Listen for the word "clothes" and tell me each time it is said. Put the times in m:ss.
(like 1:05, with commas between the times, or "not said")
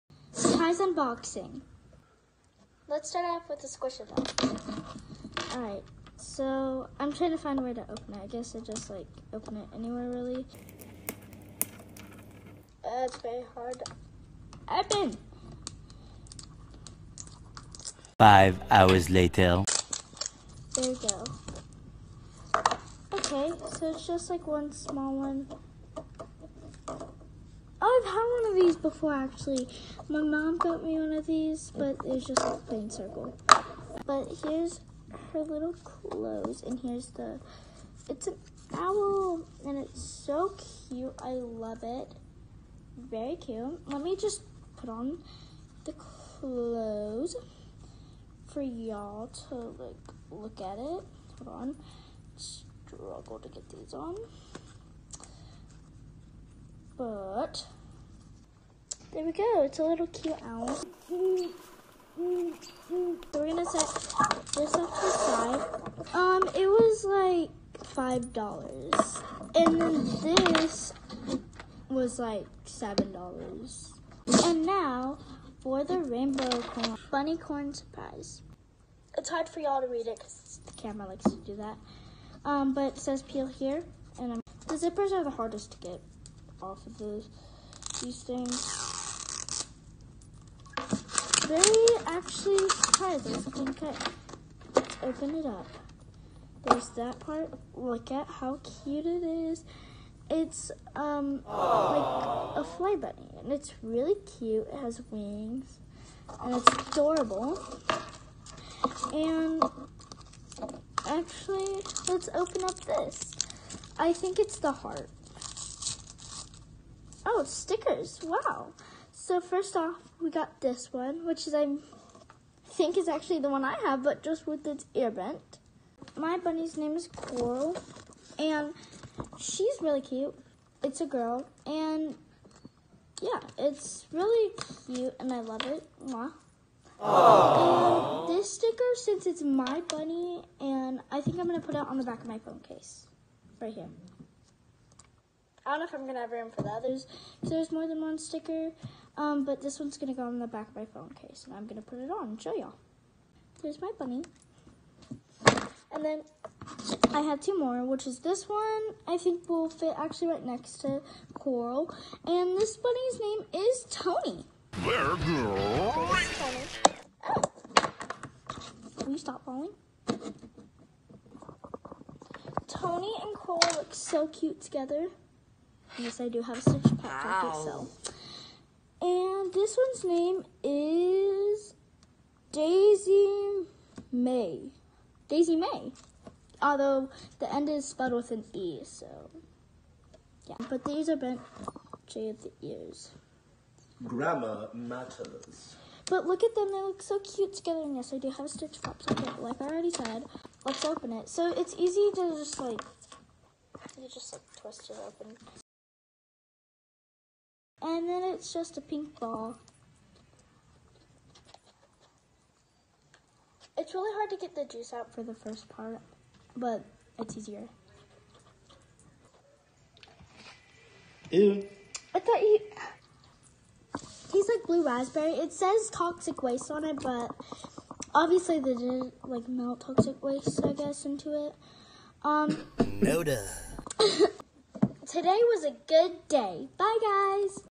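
0:35, 0:45.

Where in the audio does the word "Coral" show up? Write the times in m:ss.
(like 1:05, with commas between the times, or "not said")
2:07, 2:41, 2:53.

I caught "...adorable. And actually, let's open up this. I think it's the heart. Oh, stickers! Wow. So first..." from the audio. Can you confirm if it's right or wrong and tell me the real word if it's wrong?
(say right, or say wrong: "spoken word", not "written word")
right.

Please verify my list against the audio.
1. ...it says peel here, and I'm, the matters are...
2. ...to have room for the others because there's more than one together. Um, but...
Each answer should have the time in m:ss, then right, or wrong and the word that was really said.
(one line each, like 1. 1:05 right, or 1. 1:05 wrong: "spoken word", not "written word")
1. 1:22 wrong: "zippers", not "matters"
2. 2:26 wrong: "sticker", not "together".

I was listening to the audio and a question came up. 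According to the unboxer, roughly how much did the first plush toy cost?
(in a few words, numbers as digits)
$5.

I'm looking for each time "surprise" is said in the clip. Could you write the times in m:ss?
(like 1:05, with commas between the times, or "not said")
0:00, 1:17.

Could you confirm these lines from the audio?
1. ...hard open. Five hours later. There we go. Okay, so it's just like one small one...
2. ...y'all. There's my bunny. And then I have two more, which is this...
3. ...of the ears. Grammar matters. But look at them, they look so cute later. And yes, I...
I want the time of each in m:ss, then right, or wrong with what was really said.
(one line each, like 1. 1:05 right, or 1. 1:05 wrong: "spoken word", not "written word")
1. 0:13 right
2. 2:32 right
3. 3:12 wrong: "together", not "later".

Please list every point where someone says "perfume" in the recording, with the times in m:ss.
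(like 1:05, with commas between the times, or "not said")
not said.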